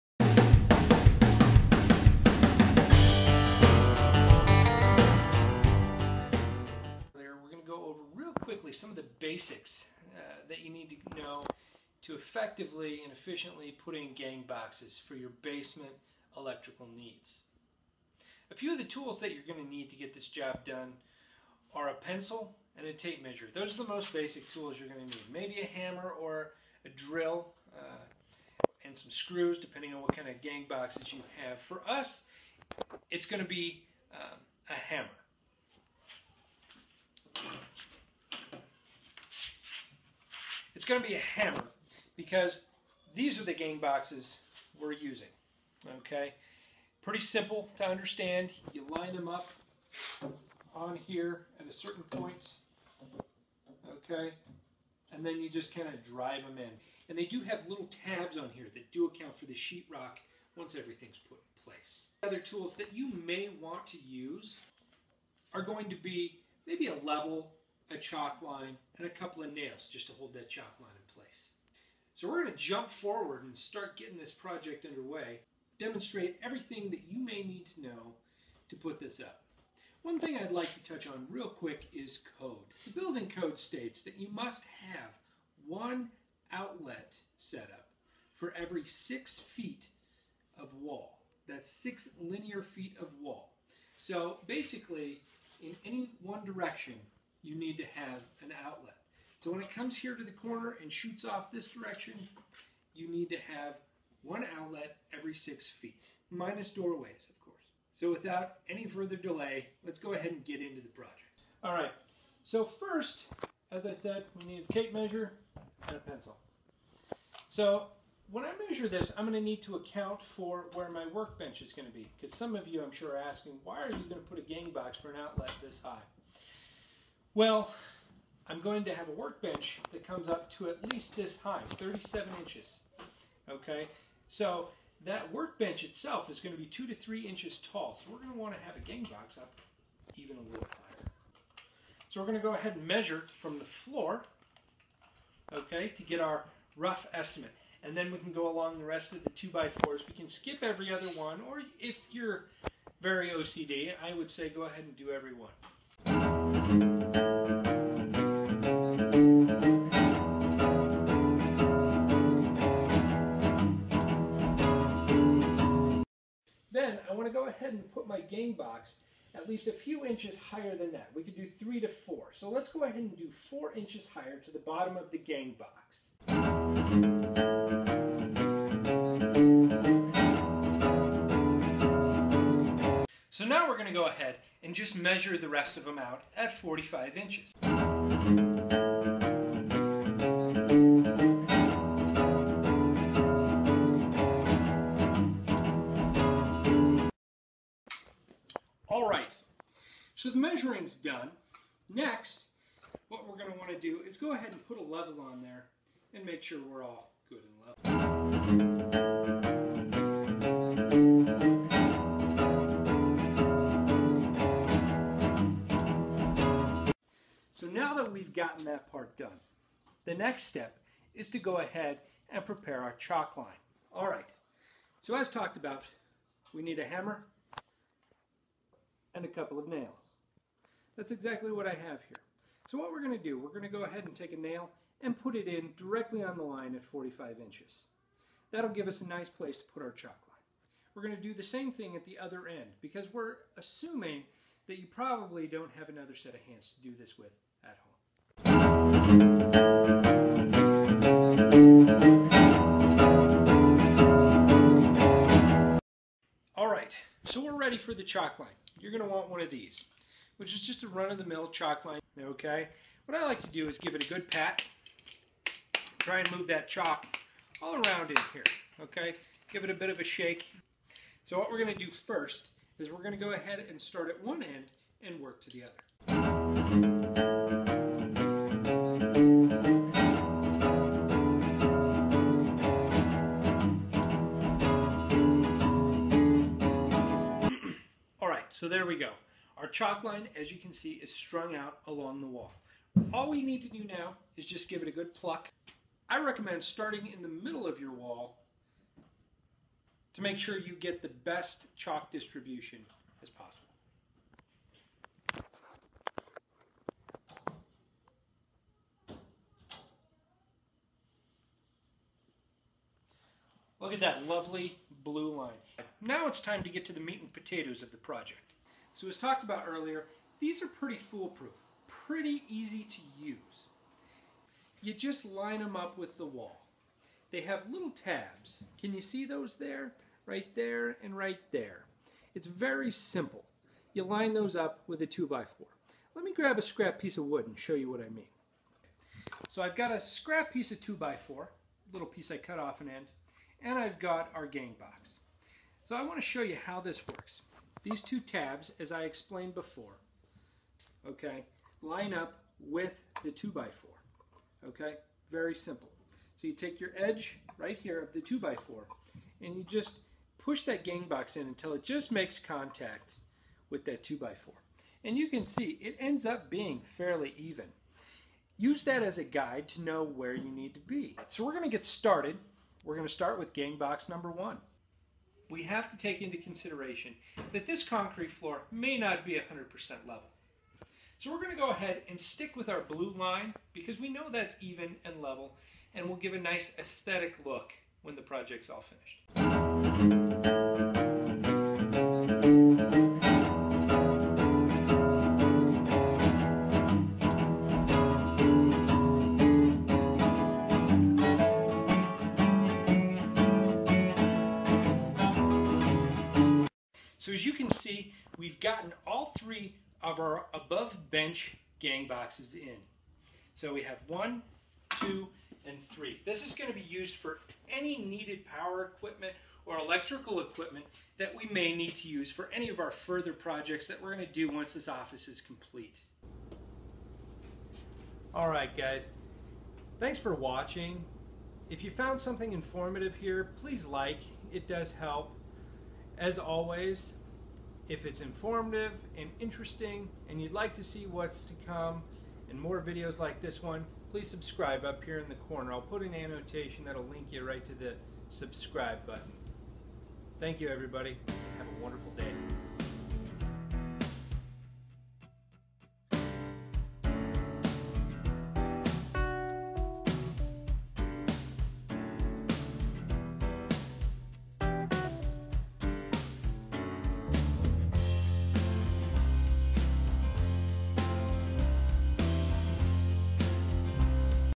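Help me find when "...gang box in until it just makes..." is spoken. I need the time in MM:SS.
06:00.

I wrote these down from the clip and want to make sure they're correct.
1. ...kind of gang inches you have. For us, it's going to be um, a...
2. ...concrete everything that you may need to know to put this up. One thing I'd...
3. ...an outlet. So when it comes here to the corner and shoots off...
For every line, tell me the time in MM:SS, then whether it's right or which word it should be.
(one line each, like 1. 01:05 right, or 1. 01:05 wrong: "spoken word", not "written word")
1. 00:30 wrong: "boxes", not "inches"
2. 01:15 wrong: "demonstrate", not "concrete"
3. 01:38 right.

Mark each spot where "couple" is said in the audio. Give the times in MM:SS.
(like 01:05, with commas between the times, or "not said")
01:09, 03:49.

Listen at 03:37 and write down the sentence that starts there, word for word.
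So now that we've gotten that part done, the next step is to go ahead and prepare our chalk line.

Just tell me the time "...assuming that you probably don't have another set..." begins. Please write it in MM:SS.
04:03.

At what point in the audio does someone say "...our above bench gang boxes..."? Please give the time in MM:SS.
06:50.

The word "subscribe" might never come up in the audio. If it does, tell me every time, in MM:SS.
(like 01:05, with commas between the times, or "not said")
07:24, 07:28.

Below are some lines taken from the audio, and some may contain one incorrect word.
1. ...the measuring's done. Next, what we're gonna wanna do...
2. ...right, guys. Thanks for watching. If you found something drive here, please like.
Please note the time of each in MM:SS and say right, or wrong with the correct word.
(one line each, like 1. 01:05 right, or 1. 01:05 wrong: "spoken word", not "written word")
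1. 03:20 right
2. 07:08 wrong: "informative", not "drive".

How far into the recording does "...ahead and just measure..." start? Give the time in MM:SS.
03:04.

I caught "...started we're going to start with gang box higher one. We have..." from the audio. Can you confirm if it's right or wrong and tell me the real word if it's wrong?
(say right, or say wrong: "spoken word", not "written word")
wrong: "number", not "higher".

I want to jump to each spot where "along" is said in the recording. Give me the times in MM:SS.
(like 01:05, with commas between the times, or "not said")
02:28, 04:51.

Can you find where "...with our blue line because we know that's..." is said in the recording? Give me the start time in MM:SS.
06:22.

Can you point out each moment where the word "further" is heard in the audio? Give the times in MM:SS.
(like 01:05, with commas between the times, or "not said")
01:48, 07:03.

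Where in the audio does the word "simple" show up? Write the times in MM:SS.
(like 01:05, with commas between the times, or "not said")
00:47, 05:32, 05:55.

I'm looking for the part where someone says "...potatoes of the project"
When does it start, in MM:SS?
05:17.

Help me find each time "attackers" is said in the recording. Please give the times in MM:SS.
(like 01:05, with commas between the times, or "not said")
not said.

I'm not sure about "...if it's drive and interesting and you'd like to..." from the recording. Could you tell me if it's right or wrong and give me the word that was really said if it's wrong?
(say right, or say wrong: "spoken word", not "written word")
wrong: "informative", not "drive".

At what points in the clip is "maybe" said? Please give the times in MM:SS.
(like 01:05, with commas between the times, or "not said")
00:25, 01:06.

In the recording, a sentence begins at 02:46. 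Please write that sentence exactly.
Then I want to go ahead and put my gang box at least a few inches higher than that.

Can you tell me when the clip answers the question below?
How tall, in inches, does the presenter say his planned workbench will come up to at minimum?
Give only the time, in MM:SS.
02:11.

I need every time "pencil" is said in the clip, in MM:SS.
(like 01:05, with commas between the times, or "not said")
00:21, 01:55.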